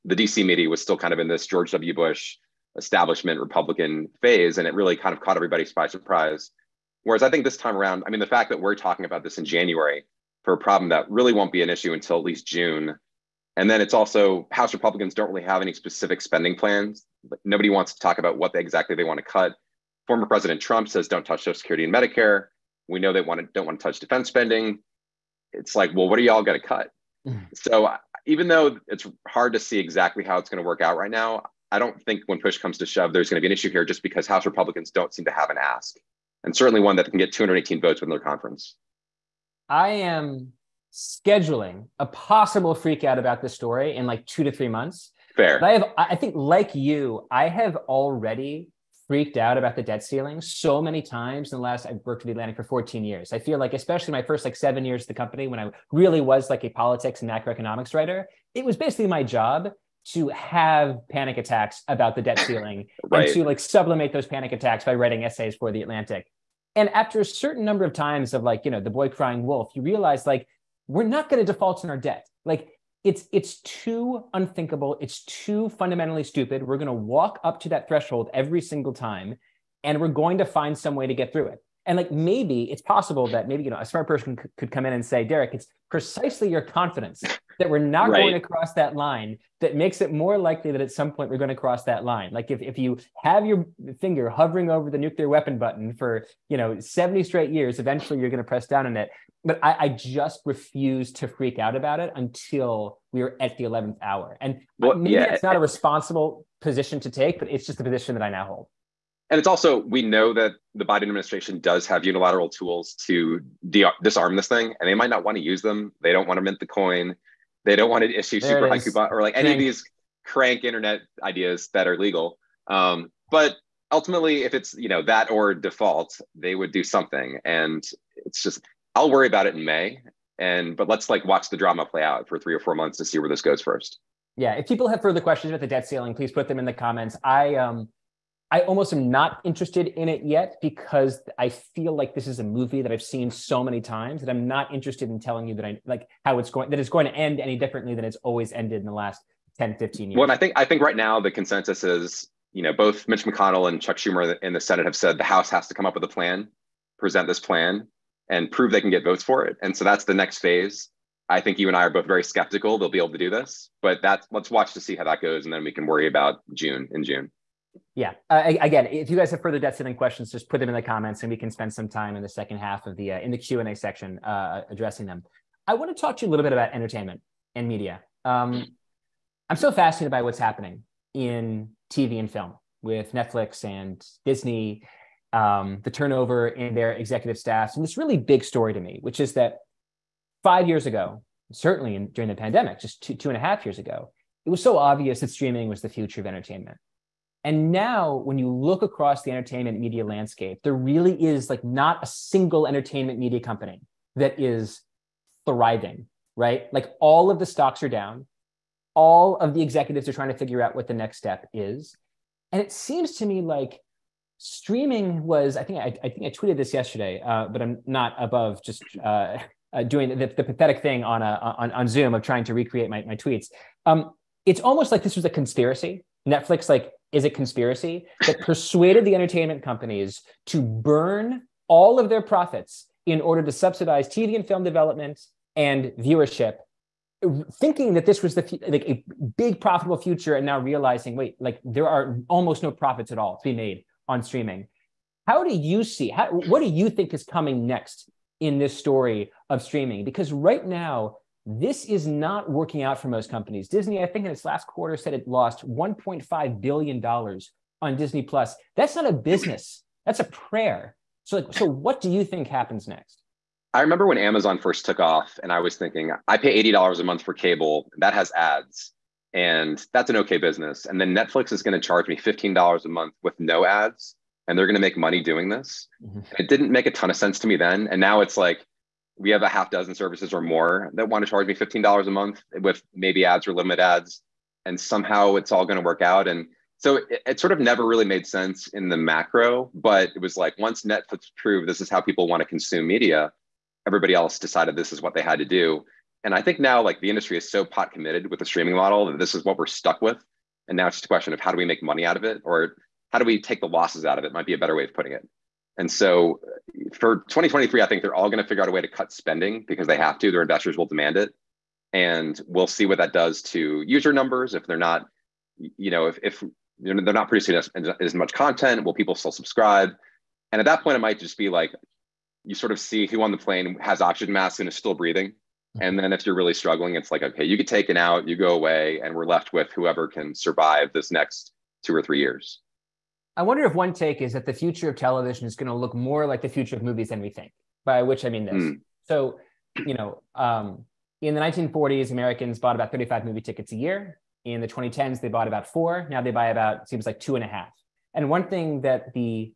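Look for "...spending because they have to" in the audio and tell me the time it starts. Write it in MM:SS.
05:09.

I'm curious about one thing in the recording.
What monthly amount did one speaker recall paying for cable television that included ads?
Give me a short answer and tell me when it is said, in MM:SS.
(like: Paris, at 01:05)
$80, at 04:26.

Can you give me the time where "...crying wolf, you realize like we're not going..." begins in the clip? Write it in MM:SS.
01:09.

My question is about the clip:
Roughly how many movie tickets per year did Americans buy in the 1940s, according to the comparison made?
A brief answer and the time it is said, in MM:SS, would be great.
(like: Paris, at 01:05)
35, at 05:42.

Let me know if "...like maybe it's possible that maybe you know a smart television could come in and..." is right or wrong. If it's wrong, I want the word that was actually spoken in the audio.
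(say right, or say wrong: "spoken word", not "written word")
wrong: "person", not "television".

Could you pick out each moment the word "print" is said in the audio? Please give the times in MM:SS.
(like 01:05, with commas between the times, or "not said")
not said.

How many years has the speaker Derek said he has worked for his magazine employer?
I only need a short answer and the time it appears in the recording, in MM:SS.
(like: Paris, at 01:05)
14, at 00:52.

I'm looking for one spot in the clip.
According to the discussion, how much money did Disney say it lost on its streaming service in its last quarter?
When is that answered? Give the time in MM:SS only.
04:15.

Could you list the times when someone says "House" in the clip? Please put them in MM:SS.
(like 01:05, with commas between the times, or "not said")
00:14, 00:34, 02:35.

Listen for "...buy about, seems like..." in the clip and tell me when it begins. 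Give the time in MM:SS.
05:46.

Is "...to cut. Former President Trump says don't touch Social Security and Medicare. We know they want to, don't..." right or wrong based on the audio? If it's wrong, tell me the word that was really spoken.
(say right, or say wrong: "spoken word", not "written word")
right.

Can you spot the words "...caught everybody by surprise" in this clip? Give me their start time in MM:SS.
00:05.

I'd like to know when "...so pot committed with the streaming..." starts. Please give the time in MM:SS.
04:57.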